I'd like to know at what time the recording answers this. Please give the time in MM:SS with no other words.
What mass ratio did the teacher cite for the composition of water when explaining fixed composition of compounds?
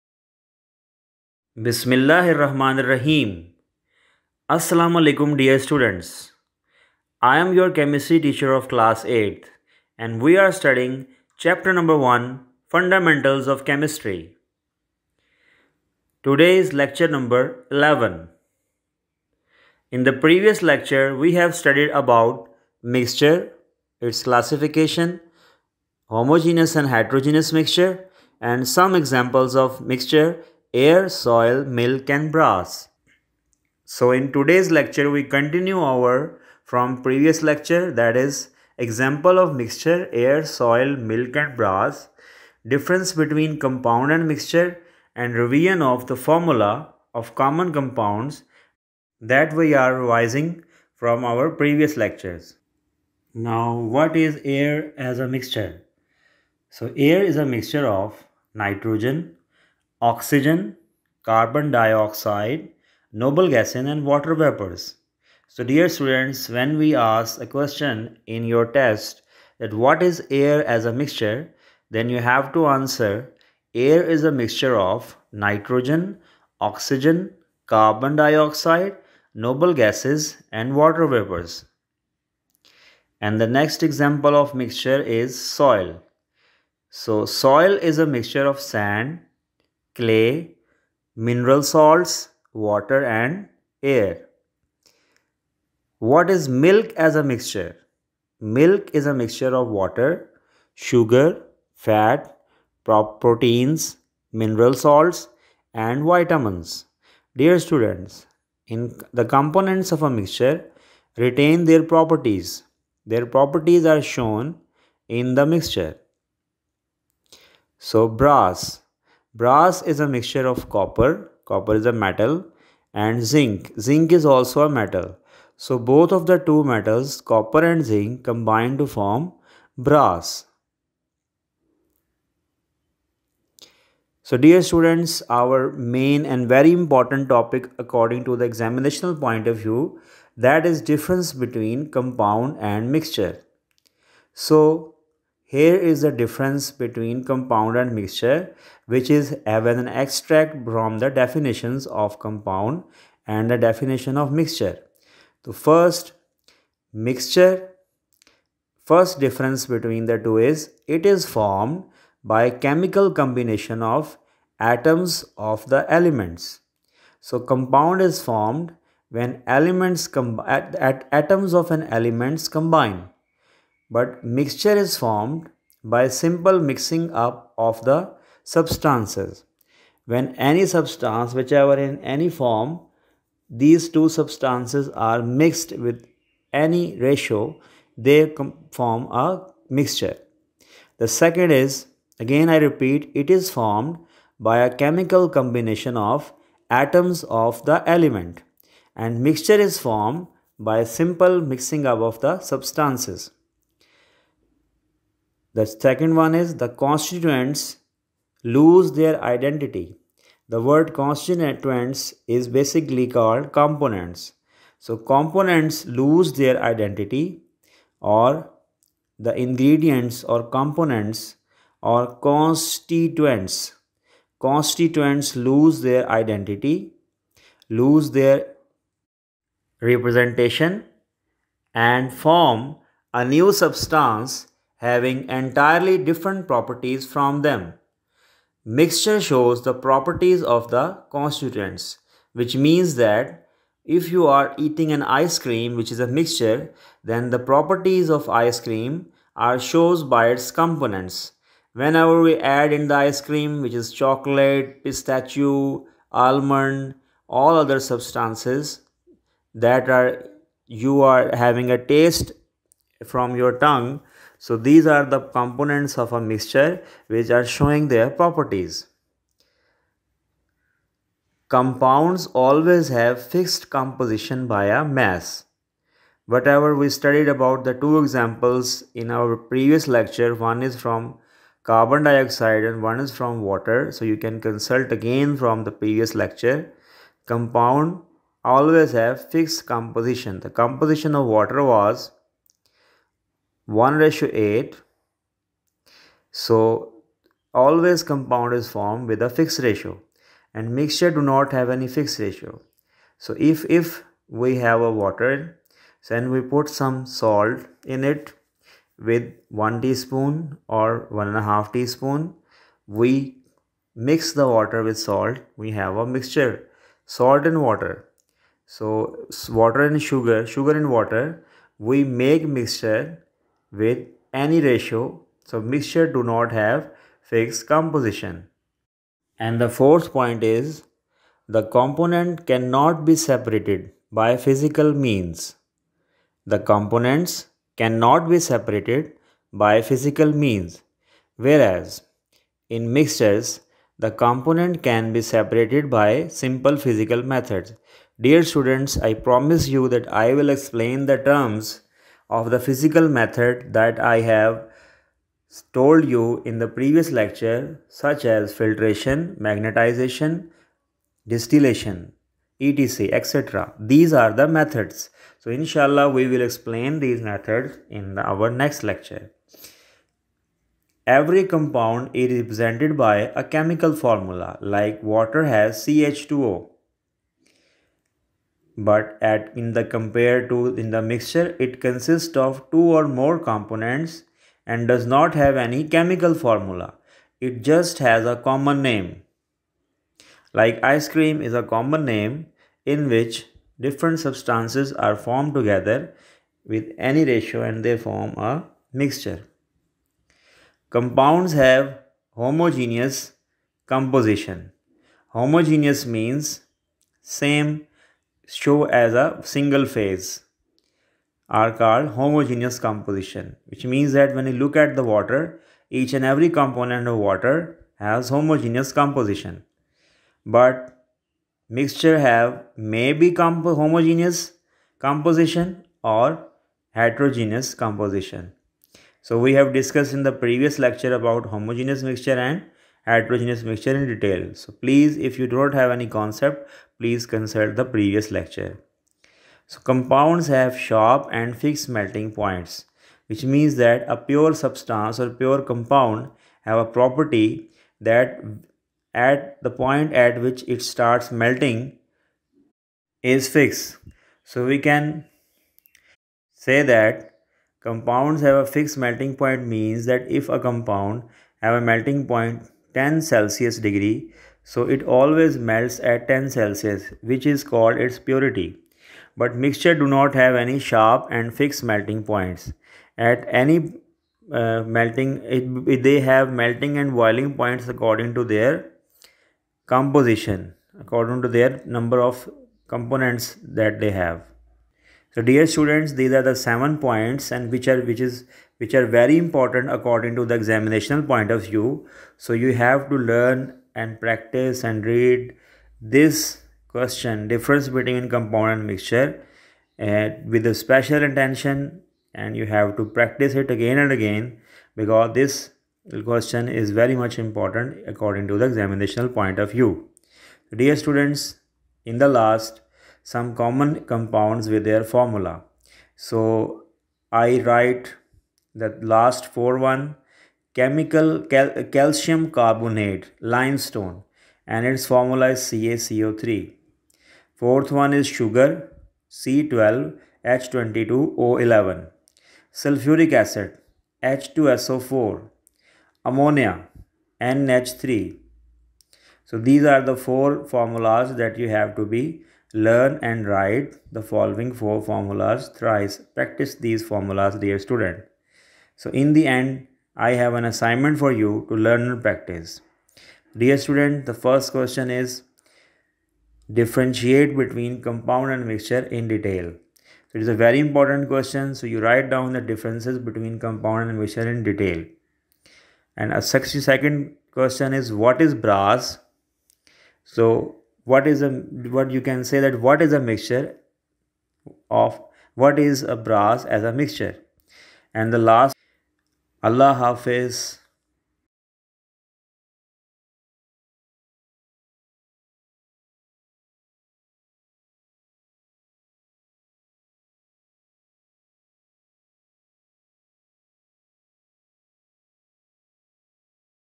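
04:53.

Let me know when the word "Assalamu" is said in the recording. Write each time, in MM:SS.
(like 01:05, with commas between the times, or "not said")
00:04.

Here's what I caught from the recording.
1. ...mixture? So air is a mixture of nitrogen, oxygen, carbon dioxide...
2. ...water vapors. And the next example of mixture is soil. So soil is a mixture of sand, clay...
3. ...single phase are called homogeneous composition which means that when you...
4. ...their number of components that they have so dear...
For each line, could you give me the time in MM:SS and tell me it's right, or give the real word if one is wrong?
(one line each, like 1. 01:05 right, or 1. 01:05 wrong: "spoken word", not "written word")
1. 00:55 right
2. 01:20 right
3. 06:49 right
4. 08:01 right.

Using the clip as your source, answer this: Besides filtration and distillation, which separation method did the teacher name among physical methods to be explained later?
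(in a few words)
magnetization.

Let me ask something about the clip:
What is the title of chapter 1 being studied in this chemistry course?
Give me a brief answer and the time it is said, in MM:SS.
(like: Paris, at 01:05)
Fundamentals of Chemistry, at 00:12.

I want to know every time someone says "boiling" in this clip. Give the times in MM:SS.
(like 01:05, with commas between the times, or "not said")
07:57.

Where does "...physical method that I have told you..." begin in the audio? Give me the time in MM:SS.
05:52.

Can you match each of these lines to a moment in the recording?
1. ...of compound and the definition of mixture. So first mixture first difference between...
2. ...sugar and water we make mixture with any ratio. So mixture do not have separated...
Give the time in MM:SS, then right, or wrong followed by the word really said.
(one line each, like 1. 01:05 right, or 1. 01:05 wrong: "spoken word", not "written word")
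1. 02:32 right
2. 05:20 wrong: "fixed", not "separated".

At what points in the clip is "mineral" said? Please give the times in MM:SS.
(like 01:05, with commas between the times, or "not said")
01:31, 01:44.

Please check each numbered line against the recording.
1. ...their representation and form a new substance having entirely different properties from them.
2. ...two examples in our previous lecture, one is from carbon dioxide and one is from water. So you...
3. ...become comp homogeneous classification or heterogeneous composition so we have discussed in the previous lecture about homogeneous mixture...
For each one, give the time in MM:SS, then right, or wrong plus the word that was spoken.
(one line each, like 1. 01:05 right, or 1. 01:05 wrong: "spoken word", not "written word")
1. 03:48 right
2. 04:37 right
3. 07:03 wrong: "composition", not "classification".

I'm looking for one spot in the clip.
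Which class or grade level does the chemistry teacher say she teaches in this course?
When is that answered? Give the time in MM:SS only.
00:08.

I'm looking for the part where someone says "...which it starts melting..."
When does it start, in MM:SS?
07:30.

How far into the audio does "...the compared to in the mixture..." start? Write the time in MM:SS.
06:19.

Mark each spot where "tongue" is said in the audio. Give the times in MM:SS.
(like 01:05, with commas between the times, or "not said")
04:23.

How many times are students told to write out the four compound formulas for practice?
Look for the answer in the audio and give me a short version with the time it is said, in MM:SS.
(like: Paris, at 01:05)
thrice, at 09:05.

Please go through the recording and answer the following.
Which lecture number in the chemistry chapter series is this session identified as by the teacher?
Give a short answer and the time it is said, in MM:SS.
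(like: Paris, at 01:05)
11, at 00:16.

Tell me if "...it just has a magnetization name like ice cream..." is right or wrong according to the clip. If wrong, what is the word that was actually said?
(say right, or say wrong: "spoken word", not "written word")
wrong: "common", not "magnetization".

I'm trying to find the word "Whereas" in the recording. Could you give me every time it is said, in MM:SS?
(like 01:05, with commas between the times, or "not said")
05:41.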